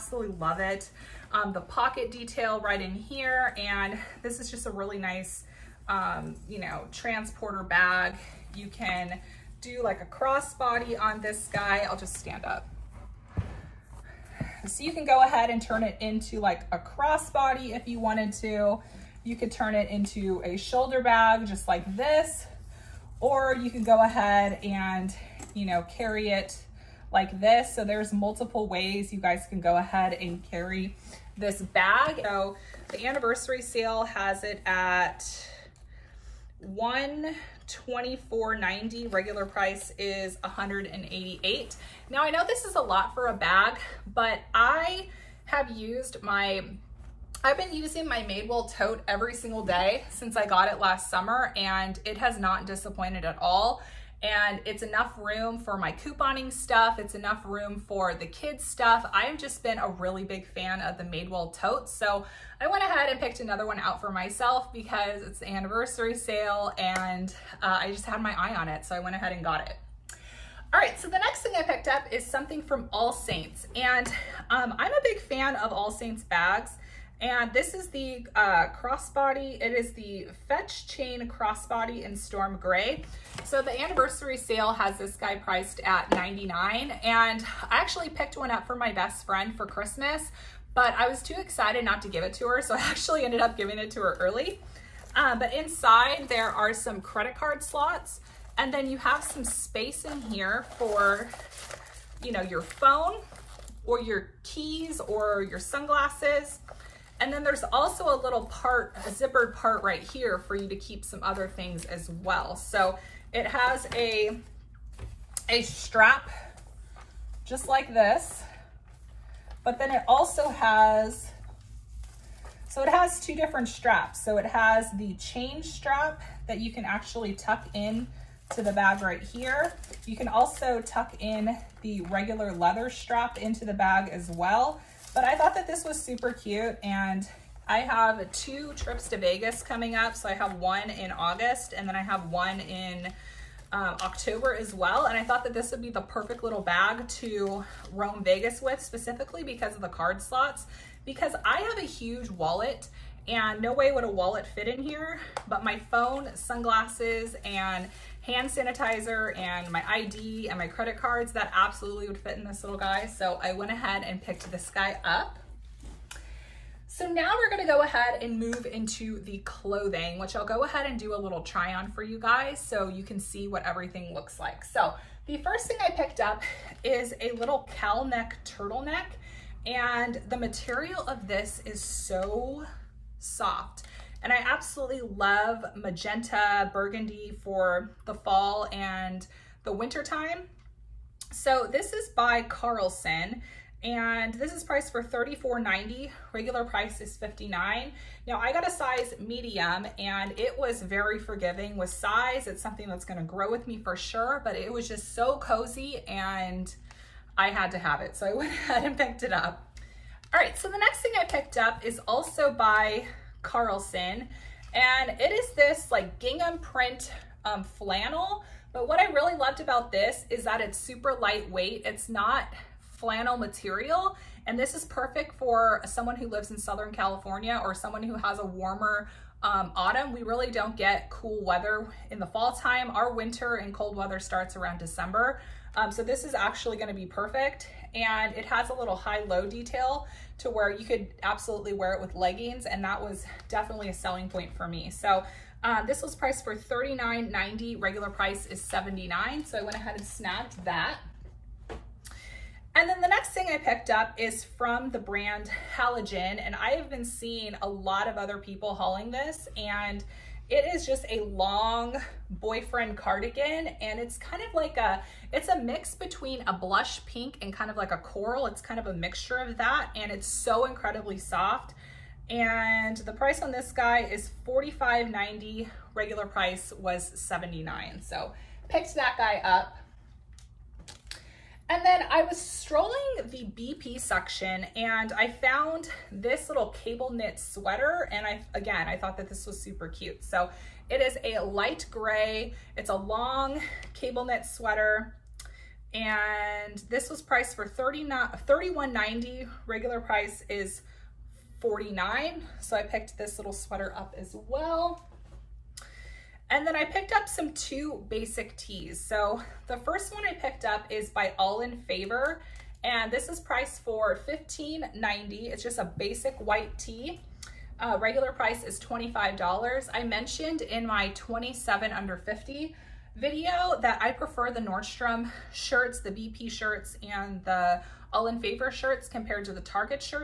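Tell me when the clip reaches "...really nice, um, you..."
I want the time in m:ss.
0:04.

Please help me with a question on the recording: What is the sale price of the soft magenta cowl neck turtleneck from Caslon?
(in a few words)
$34.90.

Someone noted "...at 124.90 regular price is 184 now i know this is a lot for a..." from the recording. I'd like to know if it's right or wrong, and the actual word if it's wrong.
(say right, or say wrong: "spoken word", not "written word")
wrong: "188", not "184".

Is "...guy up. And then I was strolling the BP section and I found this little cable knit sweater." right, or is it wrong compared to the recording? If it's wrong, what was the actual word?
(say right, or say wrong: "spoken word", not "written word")
right.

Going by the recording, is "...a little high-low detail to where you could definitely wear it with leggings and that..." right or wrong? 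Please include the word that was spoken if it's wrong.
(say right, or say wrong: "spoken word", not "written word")
wrong: "absolutely", not "definitely".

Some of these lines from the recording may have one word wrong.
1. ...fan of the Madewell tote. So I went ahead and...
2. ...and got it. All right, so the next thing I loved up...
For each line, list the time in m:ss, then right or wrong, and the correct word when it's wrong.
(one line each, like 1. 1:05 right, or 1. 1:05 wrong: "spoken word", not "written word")
1. 1:00 right
2. 1:09 wrong: "picked", not "loved".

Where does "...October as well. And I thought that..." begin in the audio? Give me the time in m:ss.
2:23.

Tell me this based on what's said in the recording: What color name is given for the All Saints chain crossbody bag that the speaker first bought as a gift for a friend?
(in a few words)
Storm Gray.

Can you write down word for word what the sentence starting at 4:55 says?
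And this was priced for 31.90.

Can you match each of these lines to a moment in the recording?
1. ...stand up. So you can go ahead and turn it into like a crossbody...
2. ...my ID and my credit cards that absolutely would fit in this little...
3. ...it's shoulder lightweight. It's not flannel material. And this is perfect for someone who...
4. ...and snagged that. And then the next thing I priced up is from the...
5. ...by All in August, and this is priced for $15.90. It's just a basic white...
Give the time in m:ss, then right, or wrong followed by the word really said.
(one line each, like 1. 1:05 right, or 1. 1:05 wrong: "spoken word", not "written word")
1. 0:12 right
2. 2:39 right
3. 3:40 wrong: "super", not "shoulder"
4. 4:09 wrong: "picked", not "priced"
5. 5:11 wrong: "Favor", not "August".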